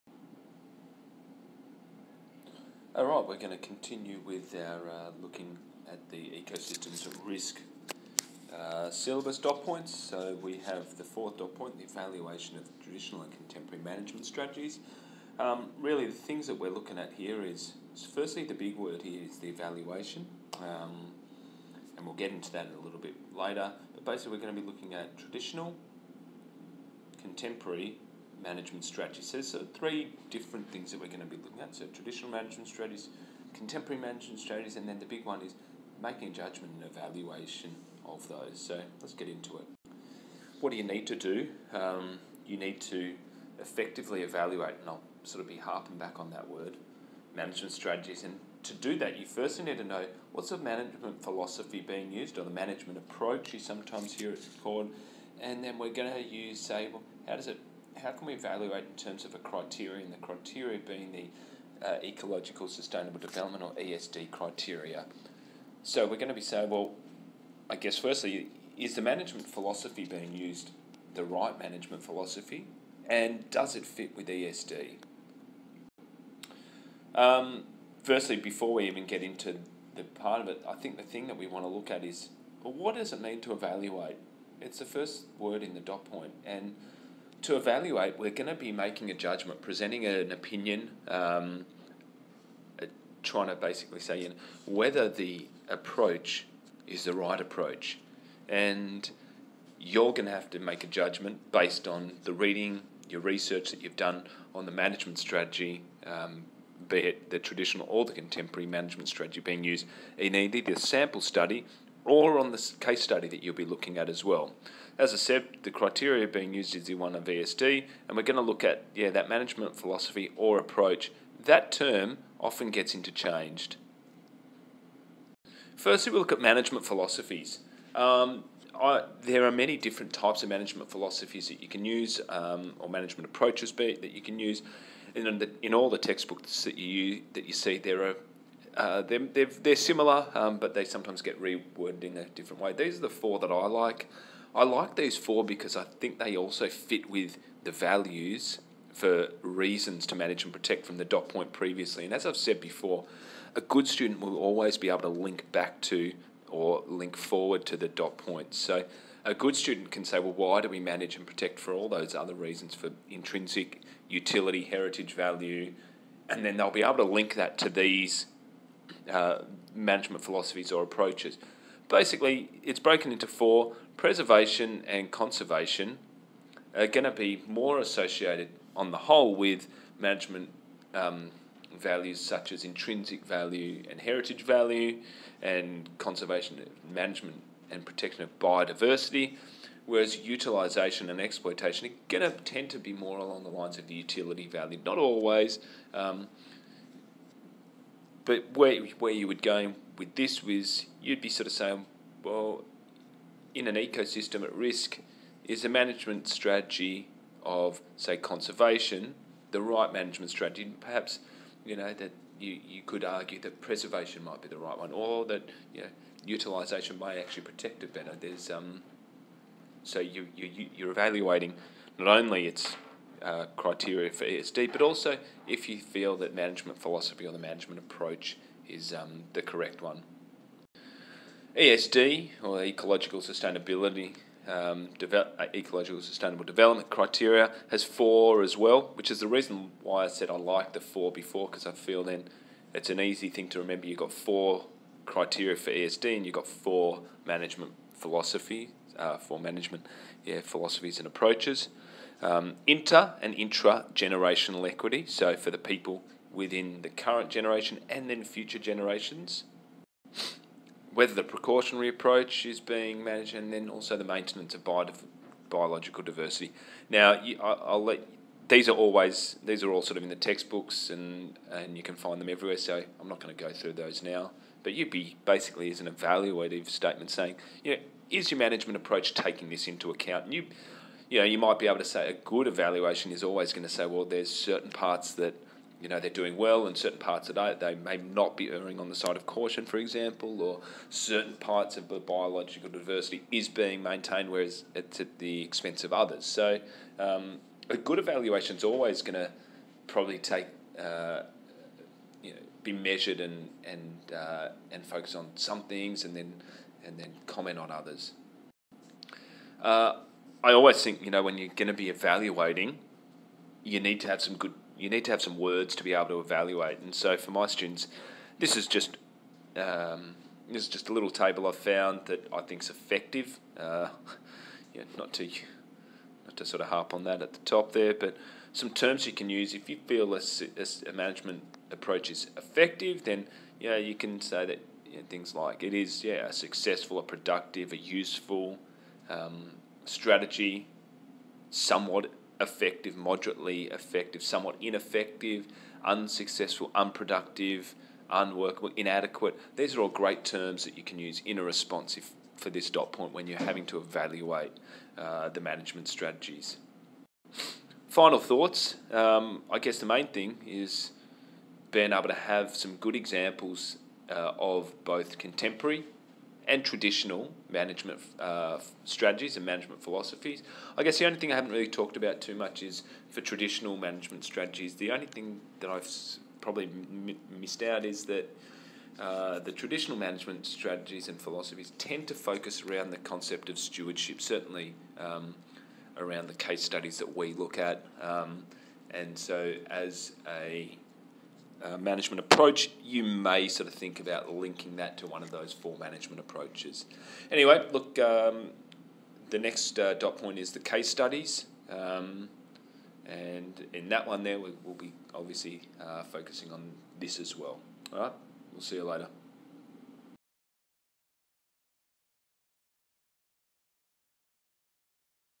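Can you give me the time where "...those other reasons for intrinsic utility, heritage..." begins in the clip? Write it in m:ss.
2:41.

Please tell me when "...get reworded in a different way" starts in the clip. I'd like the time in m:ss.
2:21.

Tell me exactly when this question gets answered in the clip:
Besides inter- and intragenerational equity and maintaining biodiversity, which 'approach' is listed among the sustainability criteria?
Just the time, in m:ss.
4:21.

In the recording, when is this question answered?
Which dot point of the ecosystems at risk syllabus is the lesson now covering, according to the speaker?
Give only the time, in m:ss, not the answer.
0:11.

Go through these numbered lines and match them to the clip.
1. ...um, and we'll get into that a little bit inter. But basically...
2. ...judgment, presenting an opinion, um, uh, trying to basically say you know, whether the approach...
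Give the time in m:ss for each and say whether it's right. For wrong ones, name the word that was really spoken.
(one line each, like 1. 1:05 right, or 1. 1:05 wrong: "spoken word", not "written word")
1. 0:20 wrong: "later", not "inter"
2. 1:29 right.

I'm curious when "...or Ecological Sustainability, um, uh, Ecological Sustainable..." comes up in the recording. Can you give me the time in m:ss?
3:52.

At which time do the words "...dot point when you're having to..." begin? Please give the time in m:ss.
5:52.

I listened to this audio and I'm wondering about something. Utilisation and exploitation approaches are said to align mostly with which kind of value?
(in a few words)
utility value.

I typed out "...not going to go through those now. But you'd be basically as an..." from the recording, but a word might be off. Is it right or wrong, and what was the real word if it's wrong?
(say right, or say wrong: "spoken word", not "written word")
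right.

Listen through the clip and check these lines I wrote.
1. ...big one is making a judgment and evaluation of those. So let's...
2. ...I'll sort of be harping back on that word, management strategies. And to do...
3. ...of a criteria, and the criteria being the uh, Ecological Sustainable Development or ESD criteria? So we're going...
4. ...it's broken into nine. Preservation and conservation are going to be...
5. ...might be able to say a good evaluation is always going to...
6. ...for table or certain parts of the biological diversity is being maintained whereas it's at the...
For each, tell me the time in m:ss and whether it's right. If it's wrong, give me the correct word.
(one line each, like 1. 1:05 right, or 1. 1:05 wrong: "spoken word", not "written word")
1. 0:35 right
2. 0:44 right
3. 0:59 right
4. 2:52 wrong: "four", not "nine"
5. 4:41 right
6. 4:49 wrong: "example", not "table".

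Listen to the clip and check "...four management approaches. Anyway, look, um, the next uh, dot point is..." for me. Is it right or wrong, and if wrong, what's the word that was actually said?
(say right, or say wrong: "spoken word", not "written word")
right.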